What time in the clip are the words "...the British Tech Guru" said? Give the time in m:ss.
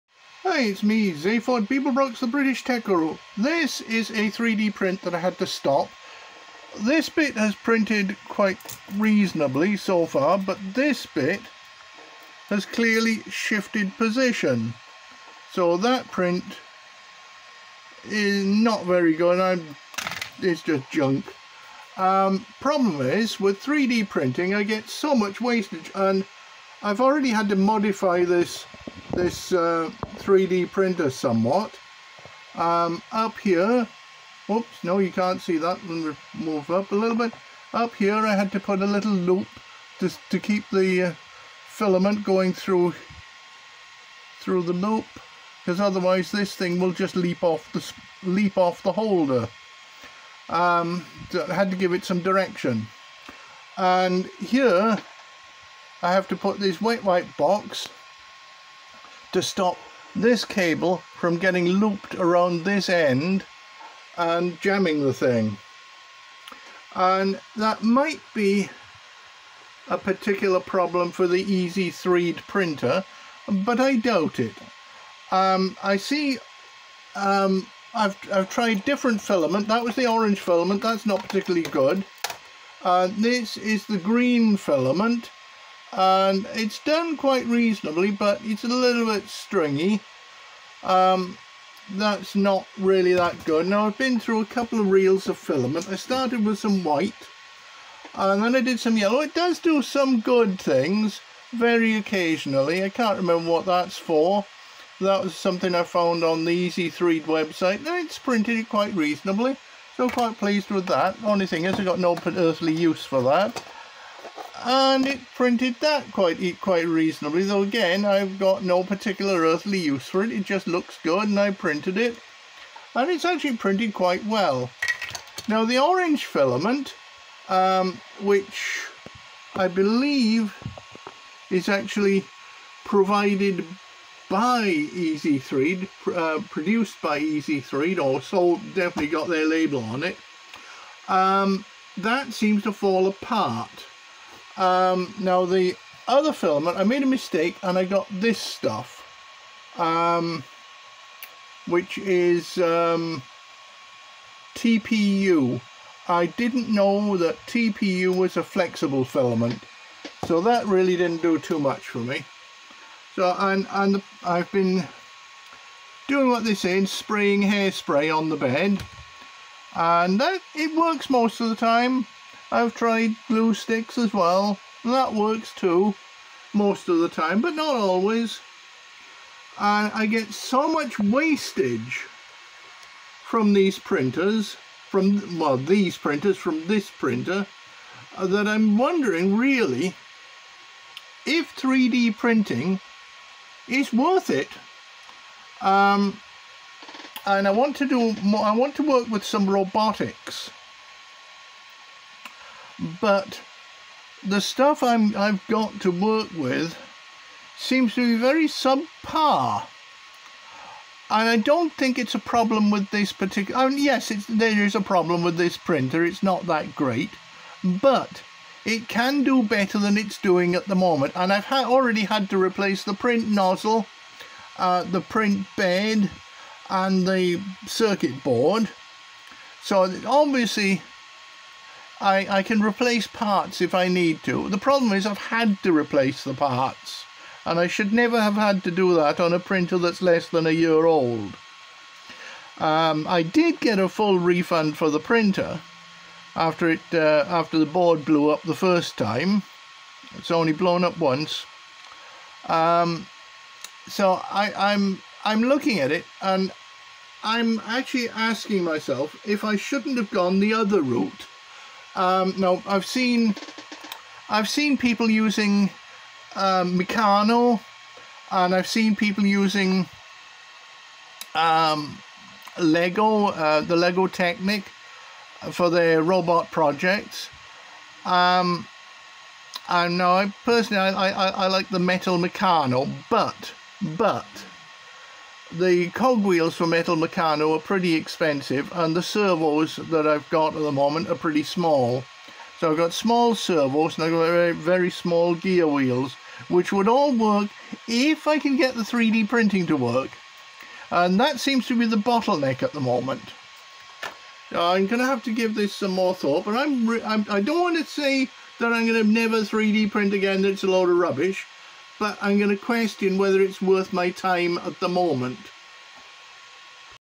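0:02.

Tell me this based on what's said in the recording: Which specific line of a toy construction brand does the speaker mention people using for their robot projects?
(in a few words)
Lego Technic.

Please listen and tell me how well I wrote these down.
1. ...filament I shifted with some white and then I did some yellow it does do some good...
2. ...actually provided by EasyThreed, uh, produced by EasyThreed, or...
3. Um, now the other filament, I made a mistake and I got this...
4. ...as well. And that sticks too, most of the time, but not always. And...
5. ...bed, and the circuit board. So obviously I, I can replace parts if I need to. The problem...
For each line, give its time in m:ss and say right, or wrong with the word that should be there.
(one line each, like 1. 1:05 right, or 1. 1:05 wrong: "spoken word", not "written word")
1. 1:35 wrong: "started", not "shifted"
2. 2:11 right
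3. 2:24 right
4. 2:53 wrong: "works", not "sticks"
5. 3:45 right.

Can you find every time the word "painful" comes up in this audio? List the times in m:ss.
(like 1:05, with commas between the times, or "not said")
not said.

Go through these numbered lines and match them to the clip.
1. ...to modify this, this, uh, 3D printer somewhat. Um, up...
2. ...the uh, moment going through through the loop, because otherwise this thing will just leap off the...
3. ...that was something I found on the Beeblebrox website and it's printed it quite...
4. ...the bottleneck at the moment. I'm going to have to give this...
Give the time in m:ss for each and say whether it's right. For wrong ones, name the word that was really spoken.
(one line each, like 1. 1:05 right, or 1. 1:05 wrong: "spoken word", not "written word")
1. 0:27 right
2. 0:40 wrong: "filament", not "moment"
3. 1:45 wrong: "EasyThreed", not "Beeblebrox"
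4. 5:01 right.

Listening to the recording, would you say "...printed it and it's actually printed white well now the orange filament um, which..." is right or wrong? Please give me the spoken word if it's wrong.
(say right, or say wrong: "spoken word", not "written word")
wrong: "quite", not "white".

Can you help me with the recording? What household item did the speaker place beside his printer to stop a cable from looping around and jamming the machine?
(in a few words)
wet wipe box.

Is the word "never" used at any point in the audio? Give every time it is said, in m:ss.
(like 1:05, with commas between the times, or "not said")
3:57, 5:09.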